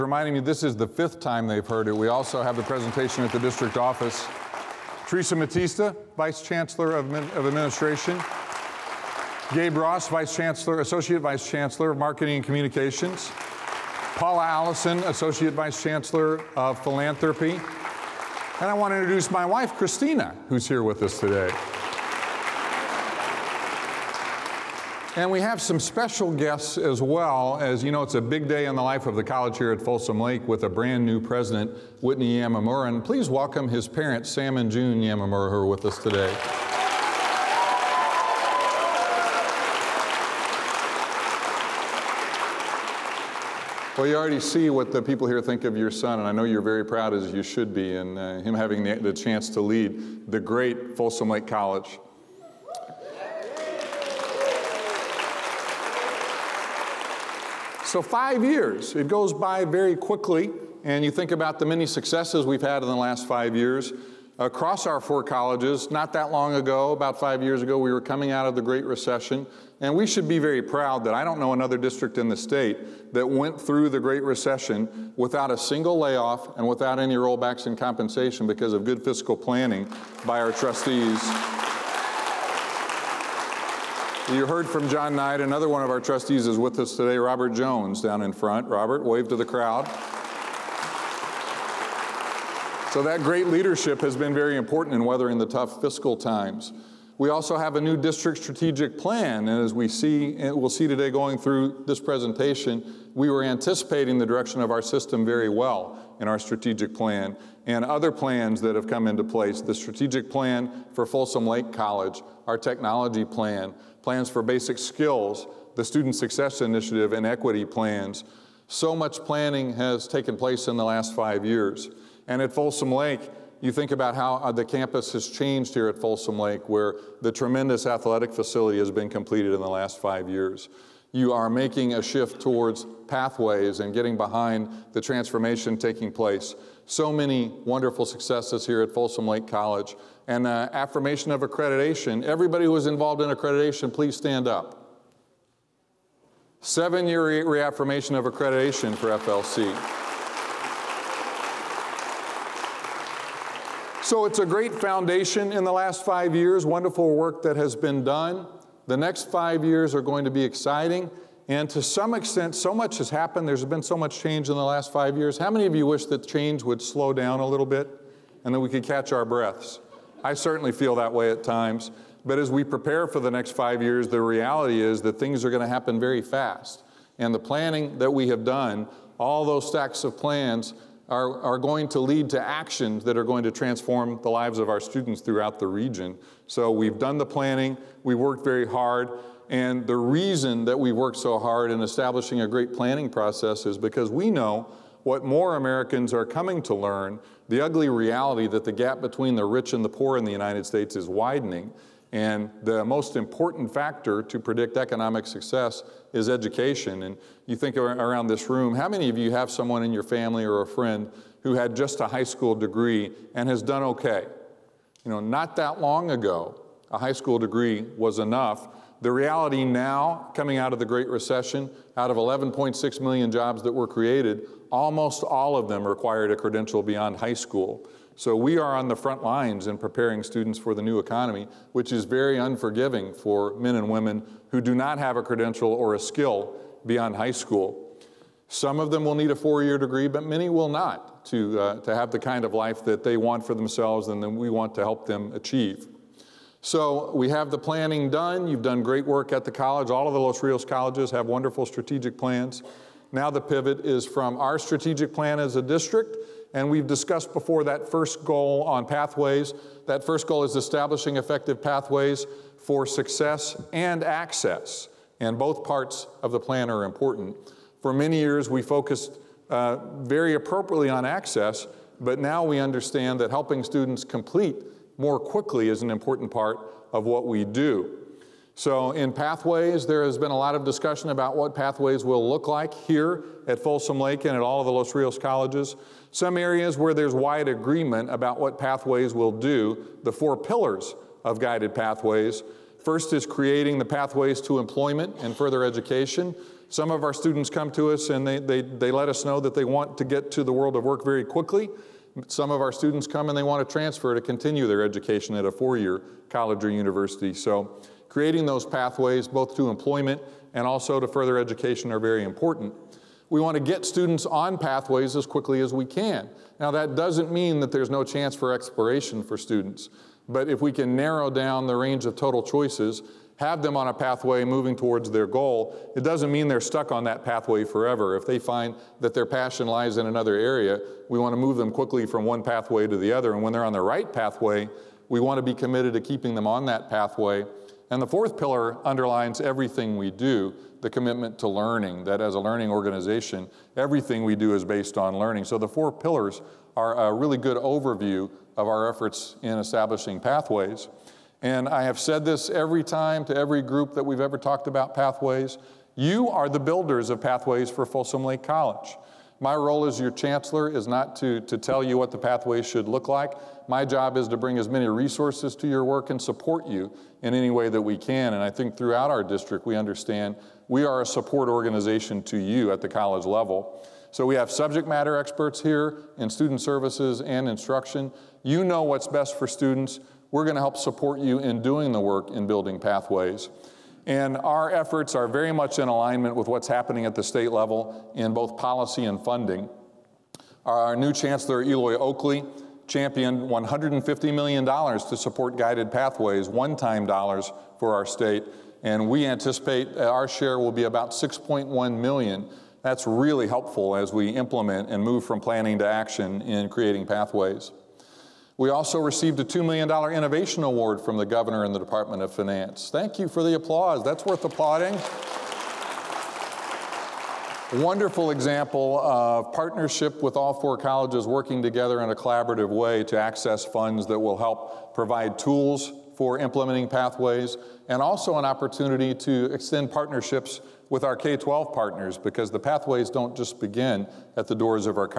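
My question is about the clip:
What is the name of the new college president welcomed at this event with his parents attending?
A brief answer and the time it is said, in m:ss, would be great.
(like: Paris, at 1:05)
Whitney Yamamura, at 0:32.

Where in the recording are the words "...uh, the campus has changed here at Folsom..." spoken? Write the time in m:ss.
2:04.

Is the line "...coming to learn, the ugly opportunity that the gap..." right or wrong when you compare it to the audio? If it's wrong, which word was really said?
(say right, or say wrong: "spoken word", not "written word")
wrong: "reality", not "opportunity".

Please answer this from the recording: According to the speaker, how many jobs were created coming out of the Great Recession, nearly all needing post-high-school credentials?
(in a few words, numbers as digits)
11.6 million.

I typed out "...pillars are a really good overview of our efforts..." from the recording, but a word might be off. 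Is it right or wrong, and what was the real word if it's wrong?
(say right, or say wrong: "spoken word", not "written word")
right.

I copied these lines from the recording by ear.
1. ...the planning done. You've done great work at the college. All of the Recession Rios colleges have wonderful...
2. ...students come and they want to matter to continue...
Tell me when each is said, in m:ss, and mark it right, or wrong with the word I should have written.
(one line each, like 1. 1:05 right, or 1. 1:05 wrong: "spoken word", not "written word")
1. 4:07 wrong: "Los", not "Recession"
2. 5:02 wrong: "transfer", not "matter".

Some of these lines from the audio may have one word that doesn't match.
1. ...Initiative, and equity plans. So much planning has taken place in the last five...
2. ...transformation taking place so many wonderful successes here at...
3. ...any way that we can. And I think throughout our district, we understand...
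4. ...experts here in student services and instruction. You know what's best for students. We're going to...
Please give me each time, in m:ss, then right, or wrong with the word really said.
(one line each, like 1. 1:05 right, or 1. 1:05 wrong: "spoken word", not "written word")
1. 1:56 right
2. 2:15 right
3. 6:07 right
4. 6:15 right.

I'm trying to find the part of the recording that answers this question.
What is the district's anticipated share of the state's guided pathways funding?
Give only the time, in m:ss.
6:41.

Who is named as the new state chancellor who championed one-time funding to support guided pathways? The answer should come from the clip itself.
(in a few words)
Eloy Oakley.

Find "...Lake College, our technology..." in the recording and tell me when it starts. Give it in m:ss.
1:51.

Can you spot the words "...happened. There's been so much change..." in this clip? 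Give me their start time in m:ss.
2:43.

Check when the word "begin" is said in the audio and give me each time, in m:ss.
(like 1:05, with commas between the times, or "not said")
7:13.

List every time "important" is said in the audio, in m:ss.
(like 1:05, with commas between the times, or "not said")
1:34, 3:23, 4:26, 4:35, 5:12.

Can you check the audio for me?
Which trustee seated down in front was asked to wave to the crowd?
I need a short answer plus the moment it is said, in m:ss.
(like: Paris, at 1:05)
Robert Jones, at 1:27.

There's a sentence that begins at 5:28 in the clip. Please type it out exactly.
If they find that their passion lies in another area, we want to move them quickly from one pathway to the other.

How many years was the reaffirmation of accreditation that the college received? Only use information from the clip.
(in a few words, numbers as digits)
7.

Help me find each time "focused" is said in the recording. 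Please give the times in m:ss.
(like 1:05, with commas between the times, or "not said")
4:28.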